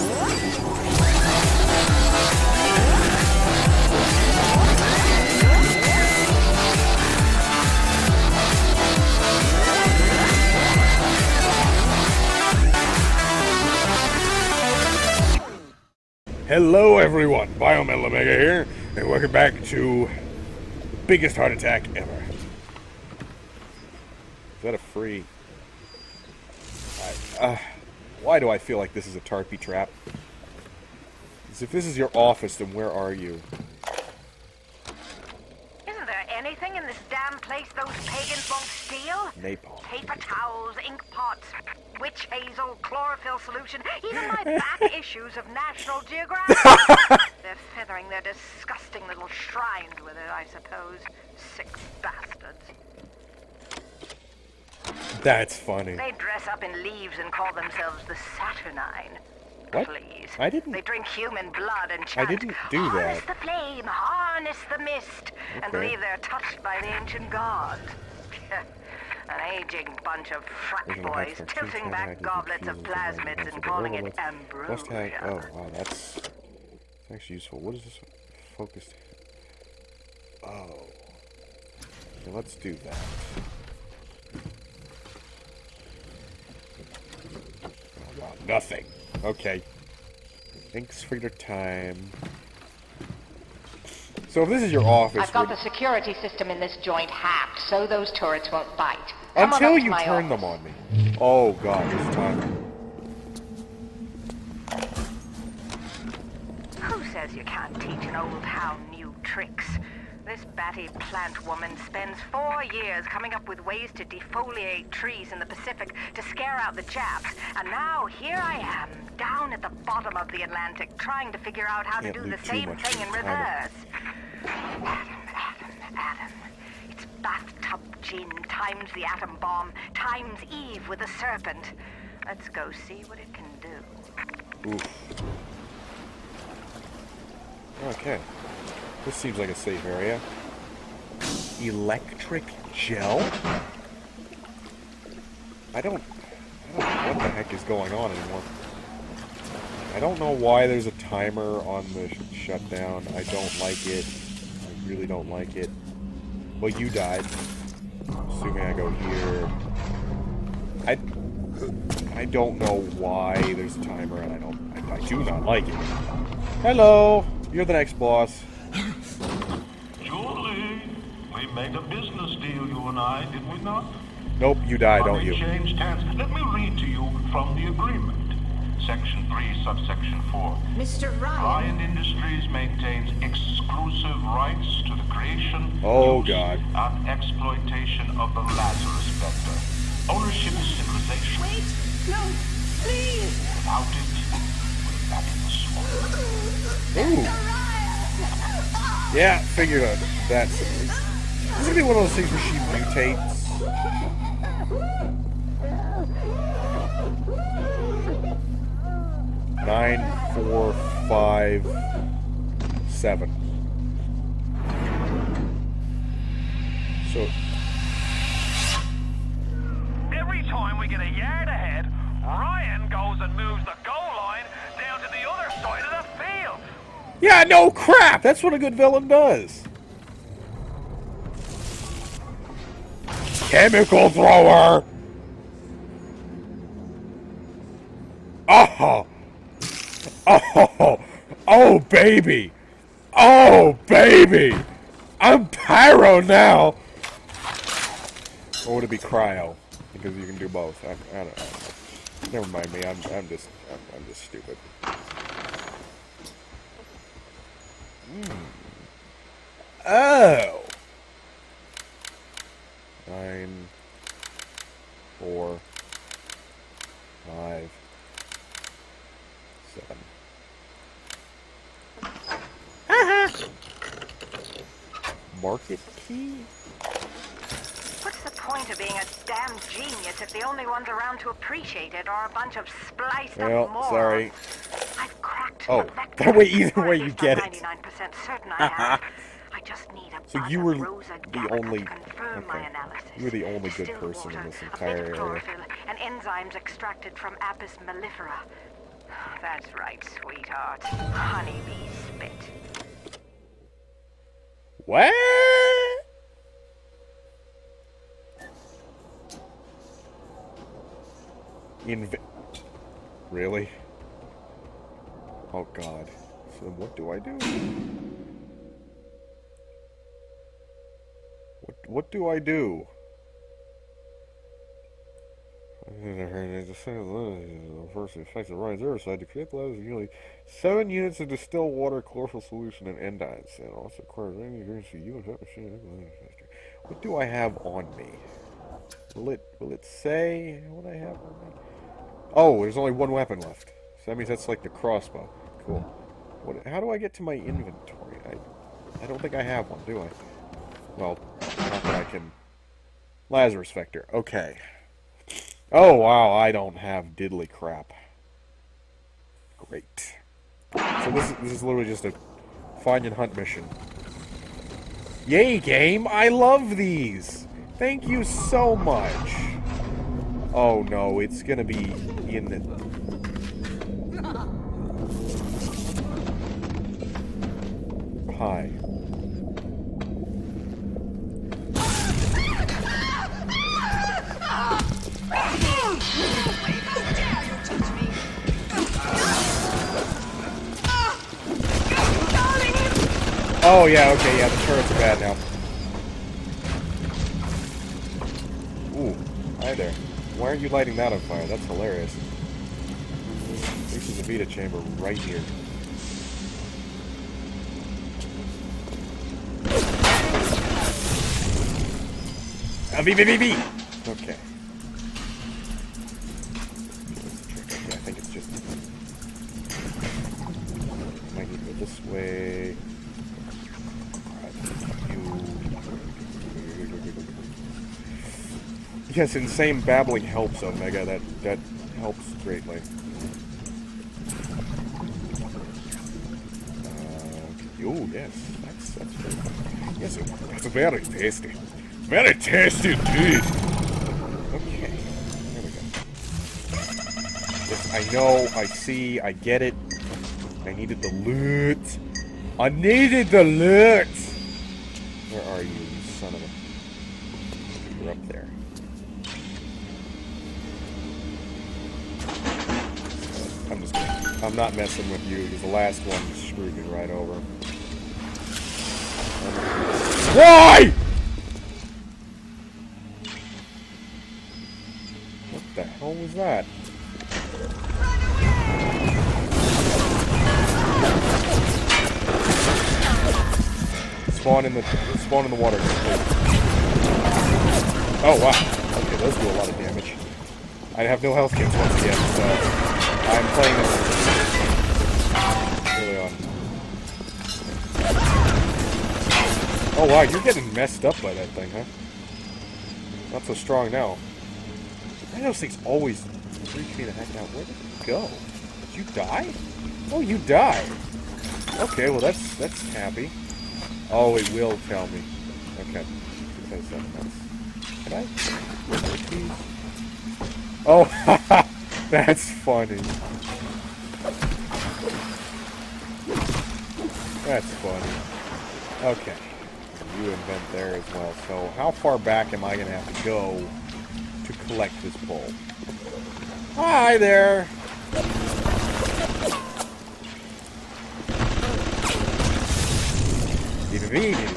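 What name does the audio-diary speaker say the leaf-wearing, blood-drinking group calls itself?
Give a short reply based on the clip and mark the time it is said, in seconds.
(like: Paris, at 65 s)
Saturnine, at 58 s.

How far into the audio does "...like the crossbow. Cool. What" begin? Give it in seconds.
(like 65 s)
344 s.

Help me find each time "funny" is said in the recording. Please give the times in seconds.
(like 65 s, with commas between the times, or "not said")
55 s, 522 s, 527 s.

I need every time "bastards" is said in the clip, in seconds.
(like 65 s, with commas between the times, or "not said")
52 s.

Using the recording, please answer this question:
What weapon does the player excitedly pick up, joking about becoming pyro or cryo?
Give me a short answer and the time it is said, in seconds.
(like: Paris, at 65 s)
chemical thrower, at 233 s.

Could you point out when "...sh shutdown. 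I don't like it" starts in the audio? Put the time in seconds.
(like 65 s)
152 s.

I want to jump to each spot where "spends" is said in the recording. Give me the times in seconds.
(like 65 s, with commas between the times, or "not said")
111 s.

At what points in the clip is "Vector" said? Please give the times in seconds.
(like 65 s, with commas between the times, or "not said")
189 s, 353 s.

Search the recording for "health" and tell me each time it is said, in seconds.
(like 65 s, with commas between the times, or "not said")
491 s.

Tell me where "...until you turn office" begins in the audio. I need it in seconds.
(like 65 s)
99 s.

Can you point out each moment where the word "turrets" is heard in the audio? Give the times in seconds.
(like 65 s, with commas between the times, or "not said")
98 s, 394 s.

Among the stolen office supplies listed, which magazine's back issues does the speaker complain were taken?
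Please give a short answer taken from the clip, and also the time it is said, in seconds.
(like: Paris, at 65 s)
National Geographic, at 45 s.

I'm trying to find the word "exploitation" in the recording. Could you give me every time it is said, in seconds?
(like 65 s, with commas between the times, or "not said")
187 s.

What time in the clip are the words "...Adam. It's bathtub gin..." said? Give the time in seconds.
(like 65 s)
125 s.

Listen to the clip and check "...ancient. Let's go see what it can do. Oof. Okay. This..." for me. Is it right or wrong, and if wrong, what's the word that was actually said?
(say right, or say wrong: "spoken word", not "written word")
wrong: "serpent", not "ancient".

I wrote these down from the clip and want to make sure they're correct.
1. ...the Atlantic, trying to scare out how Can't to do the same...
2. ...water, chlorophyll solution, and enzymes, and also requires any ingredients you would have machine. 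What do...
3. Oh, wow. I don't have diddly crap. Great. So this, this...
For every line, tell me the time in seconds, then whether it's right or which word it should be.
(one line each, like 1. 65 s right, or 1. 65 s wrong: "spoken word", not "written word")
1. 120 s wrong: "figure", not "scare"
2. 331 s right
3. 355 s right.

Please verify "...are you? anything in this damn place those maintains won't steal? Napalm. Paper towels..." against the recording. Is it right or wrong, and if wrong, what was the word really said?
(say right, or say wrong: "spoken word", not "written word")
wrong: "pagans", not "maintains".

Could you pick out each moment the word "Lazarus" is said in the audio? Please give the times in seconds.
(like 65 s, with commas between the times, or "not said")
188 s, 353 s.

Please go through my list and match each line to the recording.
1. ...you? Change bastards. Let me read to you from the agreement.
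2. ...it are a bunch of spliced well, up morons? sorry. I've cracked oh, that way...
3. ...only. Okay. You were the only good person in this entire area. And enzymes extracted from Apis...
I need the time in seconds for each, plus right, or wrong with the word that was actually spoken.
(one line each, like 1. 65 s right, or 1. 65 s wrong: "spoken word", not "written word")
1. 175 s wrong: "hands", not "bastards"
2. 281 s right
3. 291 s right.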